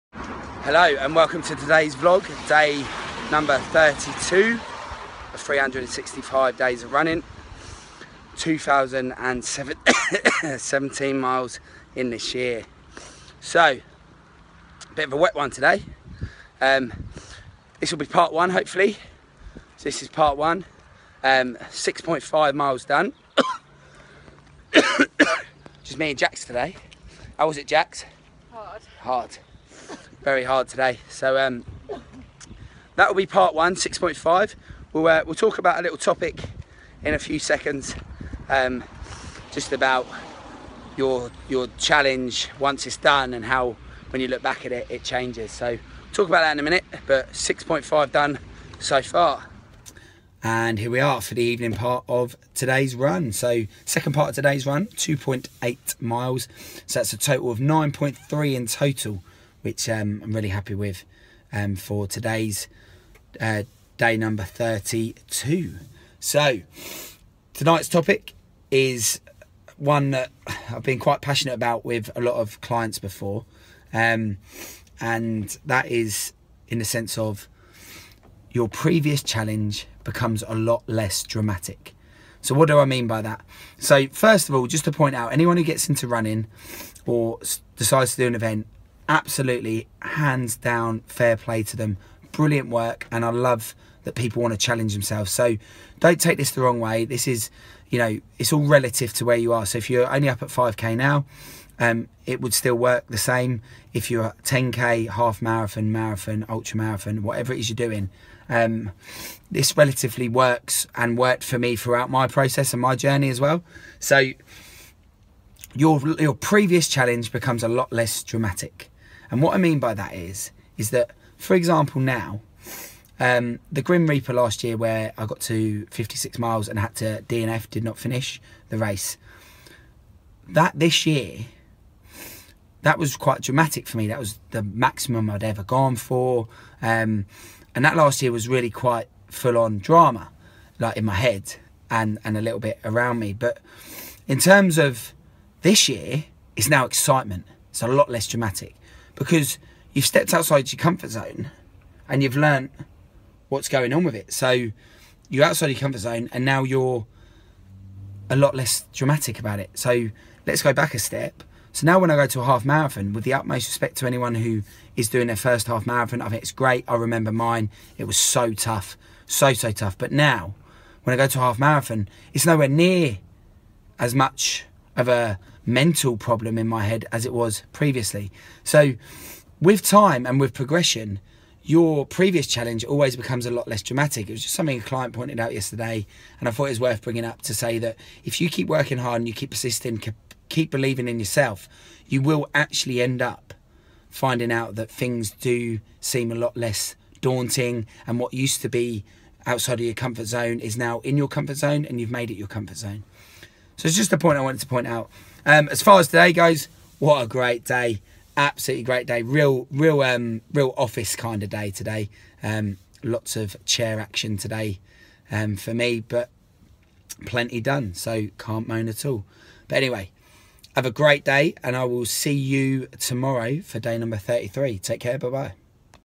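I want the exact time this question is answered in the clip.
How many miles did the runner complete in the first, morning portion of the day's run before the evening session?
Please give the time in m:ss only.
0:21.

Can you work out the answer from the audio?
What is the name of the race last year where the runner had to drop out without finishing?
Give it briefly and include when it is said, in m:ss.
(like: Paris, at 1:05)
Grim Reaper, at 2:03.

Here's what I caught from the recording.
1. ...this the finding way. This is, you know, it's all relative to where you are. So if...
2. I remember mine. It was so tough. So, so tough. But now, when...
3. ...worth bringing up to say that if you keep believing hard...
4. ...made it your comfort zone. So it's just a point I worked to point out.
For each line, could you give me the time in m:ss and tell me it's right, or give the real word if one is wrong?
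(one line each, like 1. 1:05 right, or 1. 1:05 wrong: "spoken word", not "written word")
1. 1:36 wrong: "wrong", not "finding"
2. 2:46 right
3. 3:06 wrong: "working", not "believing"
4. 3:22 wrong: "wanted", not "worked".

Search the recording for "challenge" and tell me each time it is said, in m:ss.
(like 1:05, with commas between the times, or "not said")
0:41, 1:19, 1:34, 1:56, 3:02.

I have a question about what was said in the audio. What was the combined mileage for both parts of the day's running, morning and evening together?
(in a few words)
9.3.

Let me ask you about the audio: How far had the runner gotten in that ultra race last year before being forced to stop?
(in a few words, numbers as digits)
56 miles.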